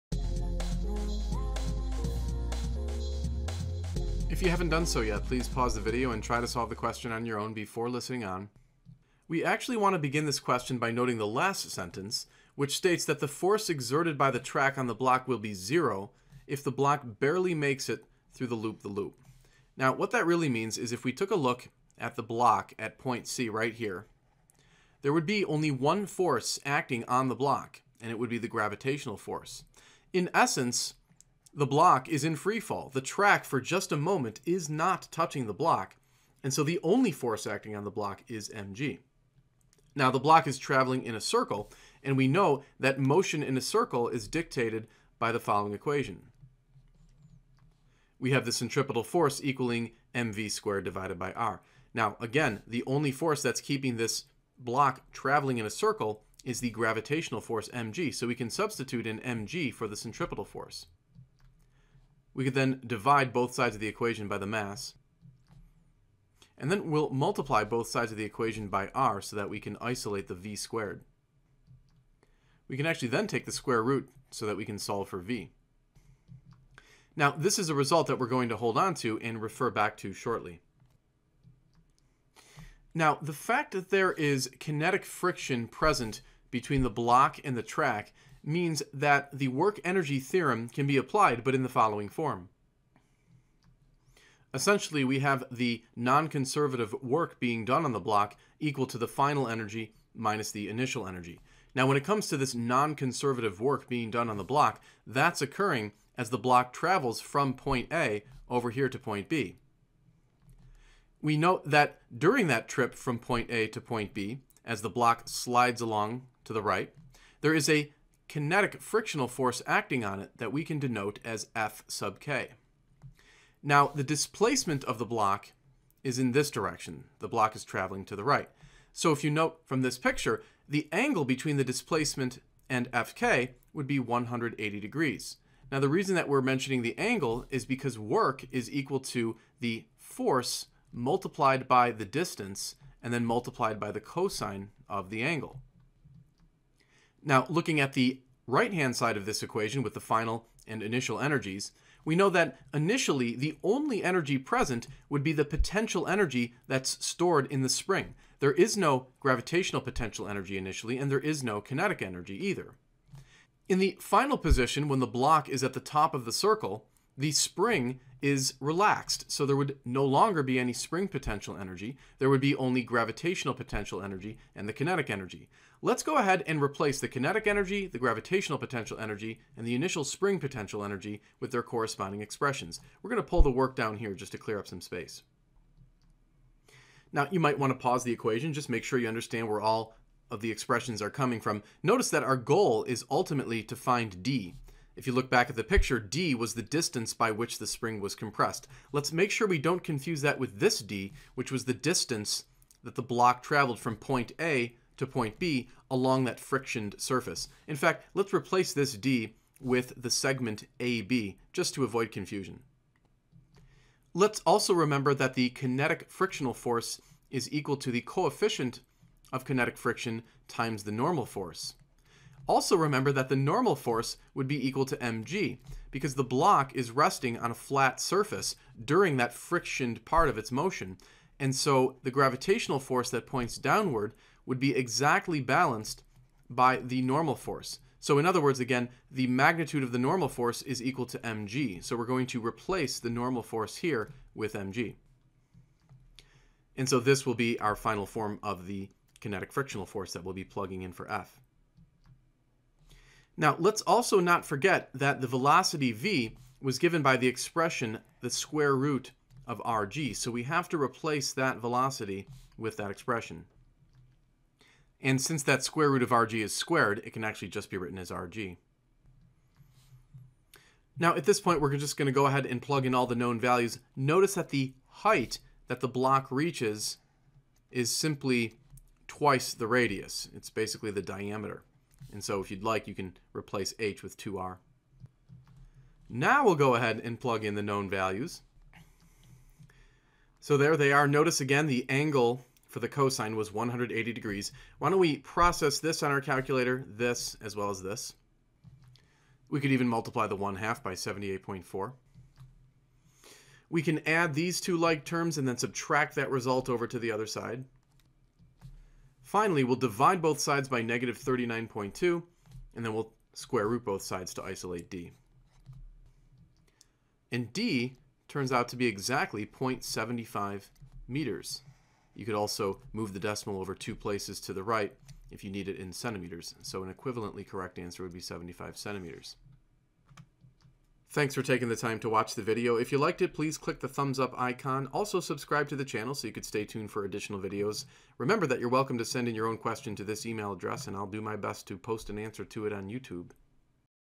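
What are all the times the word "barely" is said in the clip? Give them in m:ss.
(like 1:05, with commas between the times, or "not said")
0:17.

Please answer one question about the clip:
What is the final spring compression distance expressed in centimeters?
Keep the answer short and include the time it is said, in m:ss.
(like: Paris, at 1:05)
75 centimeters, at 5:28.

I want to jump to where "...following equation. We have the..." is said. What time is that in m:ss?
0:45.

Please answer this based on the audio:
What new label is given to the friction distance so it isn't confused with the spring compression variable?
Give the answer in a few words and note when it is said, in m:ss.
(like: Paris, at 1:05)
segment AB, at 3:29.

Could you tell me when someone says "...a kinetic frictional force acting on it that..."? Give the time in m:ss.
1:57.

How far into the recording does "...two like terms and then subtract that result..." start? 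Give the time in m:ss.
5:04.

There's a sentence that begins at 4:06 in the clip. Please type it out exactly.
And so this will be our final form of the kinetic frictional force that we'll be plugging in for F.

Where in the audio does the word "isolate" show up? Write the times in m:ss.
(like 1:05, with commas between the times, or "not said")
1:09, 5:14.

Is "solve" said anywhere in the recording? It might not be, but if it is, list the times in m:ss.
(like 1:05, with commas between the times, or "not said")
0:06, 1:14.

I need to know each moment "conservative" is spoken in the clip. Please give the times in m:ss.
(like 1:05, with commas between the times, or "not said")
1:35, 1:42.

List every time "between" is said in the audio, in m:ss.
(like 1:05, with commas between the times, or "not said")
1:26, 2:11.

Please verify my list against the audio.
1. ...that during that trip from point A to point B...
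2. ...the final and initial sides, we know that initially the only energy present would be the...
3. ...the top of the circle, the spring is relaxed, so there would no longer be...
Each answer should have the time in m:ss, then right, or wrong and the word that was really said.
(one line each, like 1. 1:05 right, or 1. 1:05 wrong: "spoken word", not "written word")
1. 1:51 right
2. 2:29 wrong: "energies", not "sides"
3. 2:45 right.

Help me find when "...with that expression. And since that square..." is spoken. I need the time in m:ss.
4:22.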